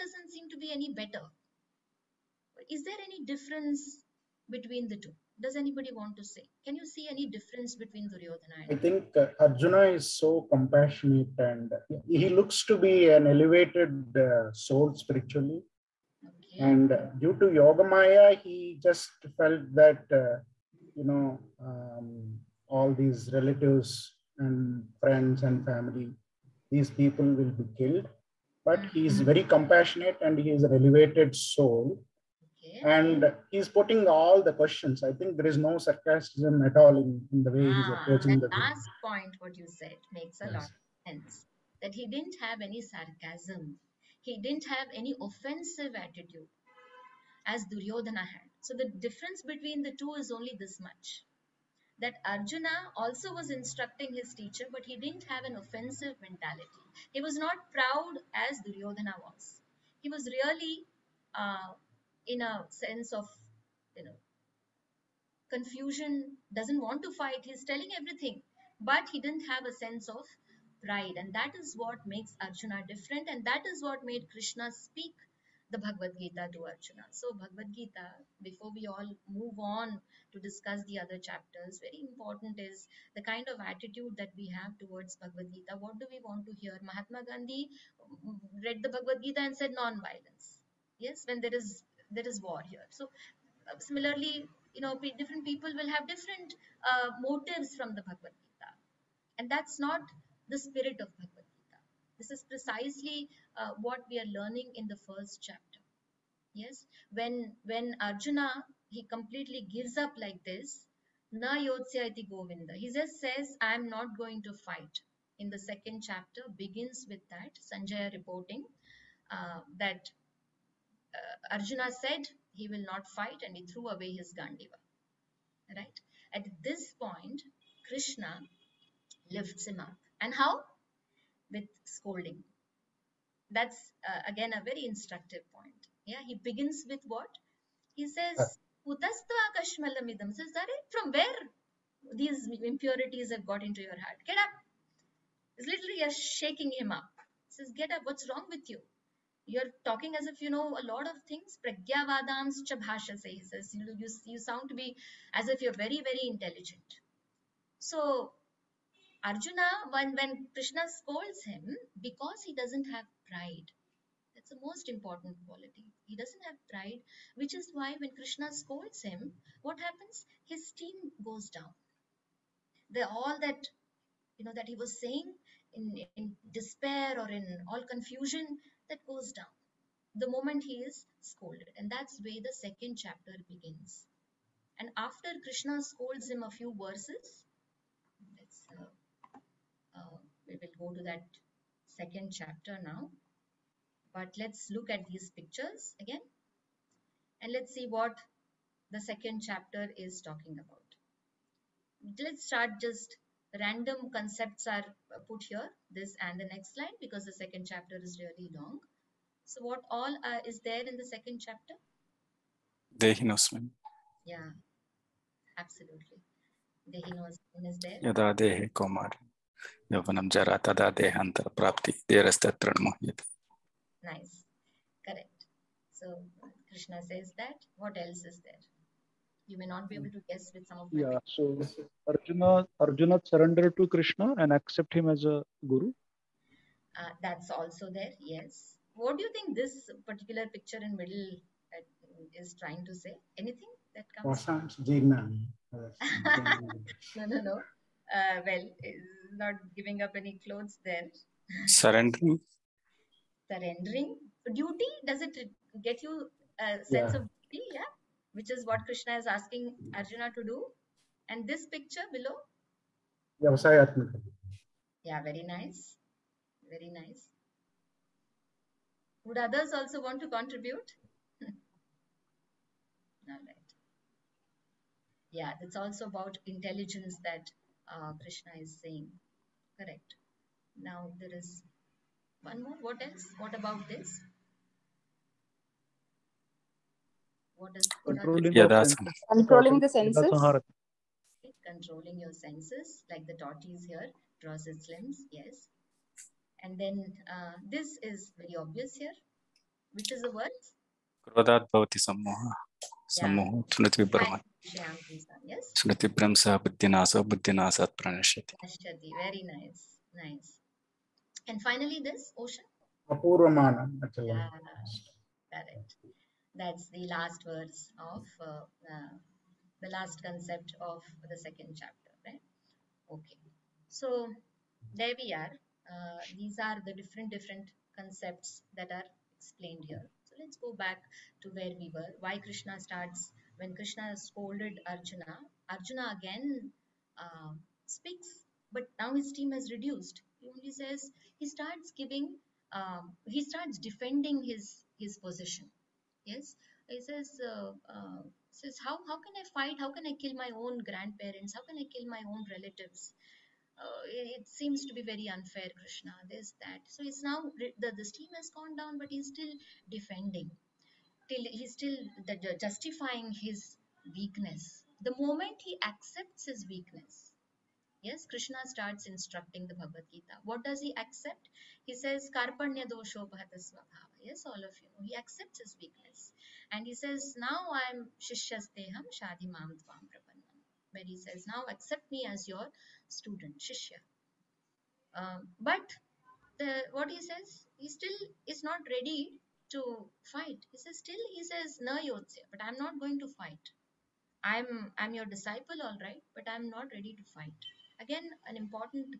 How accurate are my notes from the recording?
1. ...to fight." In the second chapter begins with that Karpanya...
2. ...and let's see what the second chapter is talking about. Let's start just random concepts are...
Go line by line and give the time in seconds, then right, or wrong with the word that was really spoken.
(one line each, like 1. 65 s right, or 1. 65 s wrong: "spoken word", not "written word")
1. 114 s wrong: "Sanjaya", not "Karpanya"
2. 197 s right.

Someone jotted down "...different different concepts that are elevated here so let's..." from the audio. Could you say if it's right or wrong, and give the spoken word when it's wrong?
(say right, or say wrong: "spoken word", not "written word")
wrong: "explained", not "elevated".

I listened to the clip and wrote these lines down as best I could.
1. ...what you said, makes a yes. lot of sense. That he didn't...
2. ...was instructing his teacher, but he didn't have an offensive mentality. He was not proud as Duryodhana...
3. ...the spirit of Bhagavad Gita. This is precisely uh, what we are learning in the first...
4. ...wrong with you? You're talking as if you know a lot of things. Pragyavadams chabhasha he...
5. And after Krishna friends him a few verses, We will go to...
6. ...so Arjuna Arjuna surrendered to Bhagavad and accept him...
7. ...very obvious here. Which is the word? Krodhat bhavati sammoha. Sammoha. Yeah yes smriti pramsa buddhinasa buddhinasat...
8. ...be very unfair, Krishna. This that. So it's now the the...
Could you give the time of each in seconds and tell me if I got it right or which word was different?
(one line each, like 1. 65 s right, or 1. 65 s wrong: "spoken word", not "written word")
1. 39 s right
2. 53 s right
3. 100 s right
4. 148 s right
5. 184 s wrong: "scolds", not "friends"
6. 231 s wrong: "Krishna", not "Bhagavad"
7. 298 s right
8. 354 s right.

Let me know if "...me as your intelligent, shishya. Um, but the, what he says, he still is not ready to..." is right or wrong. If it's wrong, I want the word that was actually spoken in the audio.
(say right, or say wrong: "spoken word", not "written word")
wrong: "student", not "intelligent".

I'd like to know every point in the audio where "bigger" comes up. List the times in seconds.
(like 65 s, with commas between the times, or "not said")
not said.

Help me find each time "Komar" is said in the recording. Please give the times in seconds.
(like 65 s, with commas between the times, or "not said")
218 s.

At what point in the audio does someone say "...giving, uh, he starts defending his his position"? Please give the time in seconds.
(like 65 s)
341 s.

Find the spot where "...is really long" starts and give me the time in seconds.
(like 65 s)
208 s.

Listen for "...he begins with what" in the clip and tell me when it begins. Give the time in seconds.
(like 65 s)
136 s.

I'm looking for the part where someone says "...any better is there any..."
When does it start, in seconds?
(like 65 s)
0 s.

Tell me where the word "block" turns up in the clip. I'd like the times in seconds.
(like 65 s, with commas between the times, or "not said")
not said.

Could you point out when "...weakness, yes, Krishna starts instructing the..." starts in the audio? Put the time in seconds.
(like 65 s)
366 s.